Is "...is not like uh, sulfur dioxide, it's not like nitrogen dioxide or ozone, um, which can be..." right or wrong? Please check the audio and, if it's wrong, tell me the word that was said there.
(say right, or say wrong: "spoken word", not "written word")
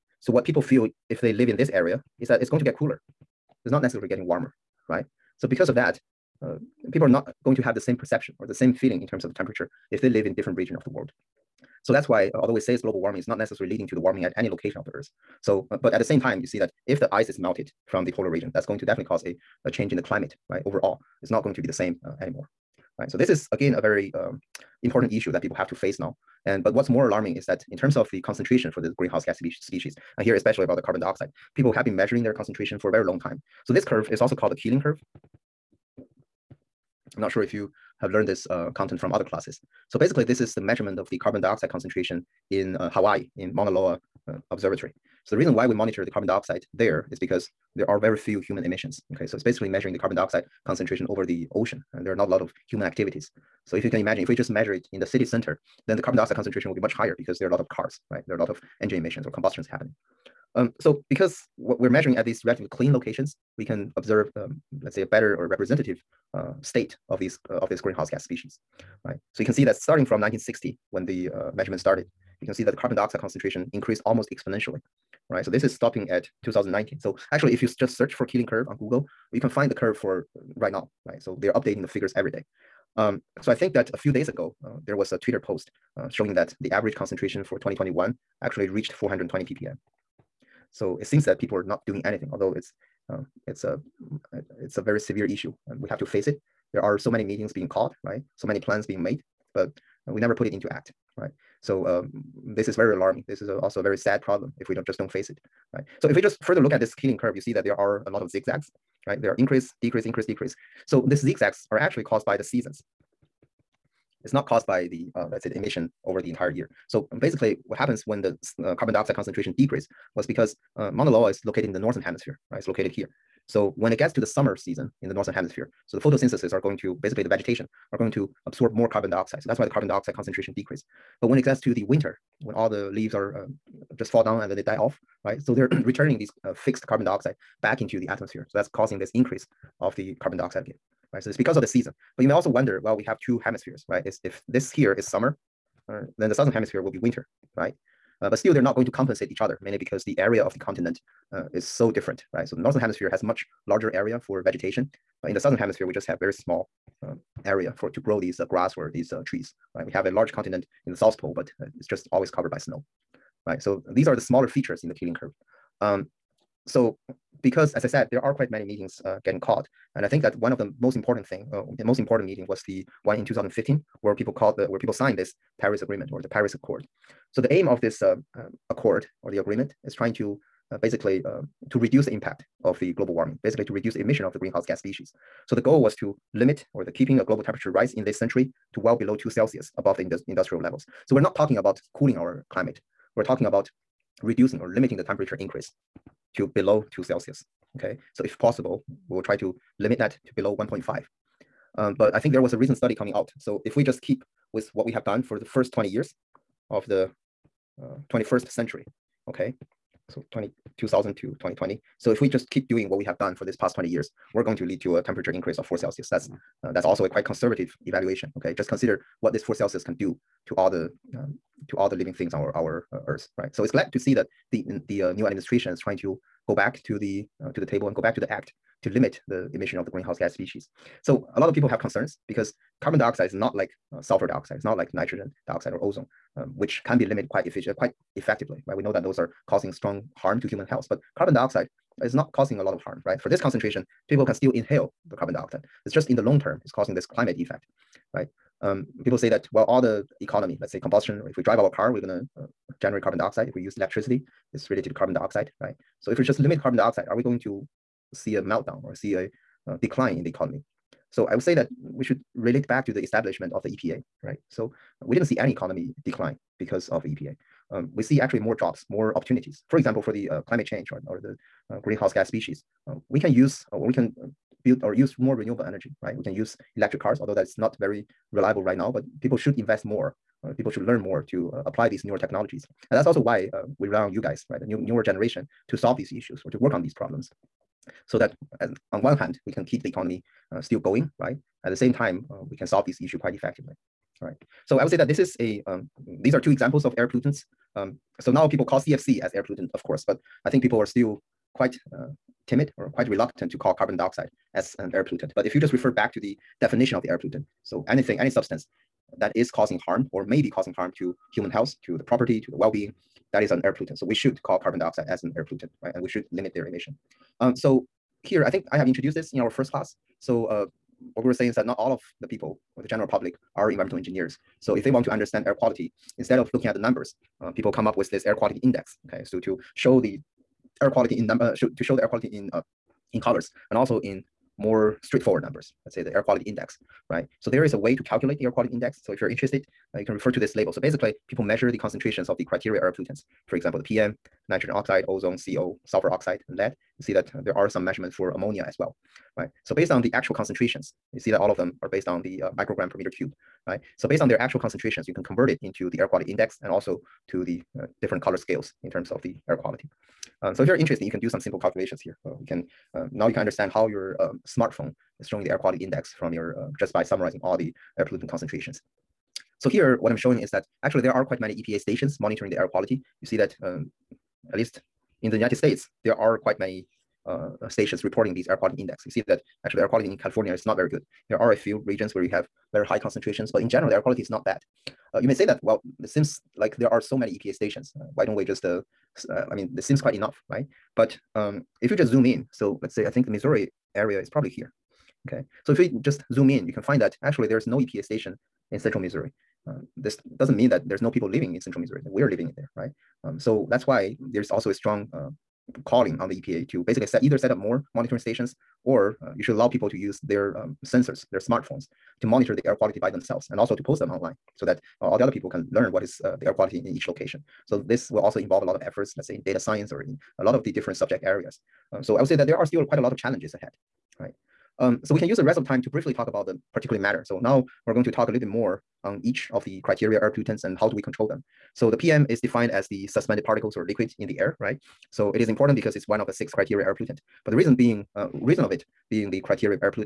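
right.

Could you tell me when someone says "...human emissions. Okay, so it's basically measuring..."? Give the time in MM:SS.
00:48.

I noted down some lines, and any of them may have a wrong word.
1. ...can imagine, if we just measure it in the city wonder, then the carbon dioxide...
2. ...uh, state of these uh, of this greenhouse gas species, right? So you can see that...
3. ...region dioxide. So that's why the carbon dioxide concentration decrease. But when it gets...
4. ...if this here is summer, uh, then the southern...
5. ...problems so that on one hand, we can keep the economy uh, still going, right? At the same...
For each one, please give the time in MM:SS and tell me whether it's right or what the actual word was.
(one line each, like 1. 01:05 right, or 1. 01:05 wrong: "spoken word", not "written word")
1. 00:53 wrong: "center", not "wonder"
2. 01:06 right
3. 02:08 wrong: "carbon", not "region"
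4. 02:24 right
5. 04:46 right.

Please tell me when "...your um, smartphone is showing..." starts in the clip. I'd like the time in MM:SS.
06:03.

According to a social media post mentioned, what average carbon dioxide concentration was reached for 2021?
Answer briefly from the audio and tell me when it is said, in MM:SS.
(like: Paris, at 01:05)
420 ppm, at 01:28.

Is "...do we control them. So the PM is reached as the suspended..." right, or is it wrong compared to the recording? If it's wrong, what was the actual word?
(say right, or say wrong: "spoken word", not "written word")
wrong: "defined", not "reached".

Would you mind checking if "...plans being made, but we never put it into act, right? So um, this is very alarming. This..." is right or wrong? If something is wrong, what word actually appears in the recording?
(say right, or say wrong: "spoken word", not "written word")
right.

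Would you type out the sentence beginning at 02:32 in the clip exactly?
So the northern hemisphere has much larger area for vegetation.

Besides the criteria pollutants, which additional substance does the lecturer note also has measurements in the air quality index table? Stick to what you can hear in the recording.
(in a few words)
ammonia.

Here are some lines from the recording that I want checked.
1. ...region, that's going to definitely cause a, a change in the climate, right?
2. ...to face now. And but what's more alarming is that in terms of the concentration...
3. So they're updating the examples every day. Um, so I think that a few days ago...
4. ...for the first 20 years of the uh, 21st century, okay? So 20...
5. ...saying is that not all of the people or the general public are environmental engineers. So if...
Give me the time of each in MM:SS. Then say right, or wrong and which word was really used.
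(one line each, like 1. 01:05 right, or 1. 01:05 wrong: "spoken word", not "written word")
1. 00:18 right
2. 00:25 right
3. 01:21 wrong: "figures", not "examples"
4. 03:25 right
5. 05:21 right.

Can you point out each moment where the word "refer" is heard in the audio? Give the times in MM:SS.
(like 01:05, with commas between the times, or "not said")
05:05, 05:40.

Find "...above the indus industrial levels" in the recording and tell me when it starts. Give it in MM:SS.
03:09.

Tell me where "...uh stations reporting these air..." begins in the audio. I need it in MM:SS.
06:17.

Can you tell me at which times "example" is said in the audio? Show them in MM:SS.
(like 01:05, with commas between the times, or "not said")
04:29, 04:56, 05:43.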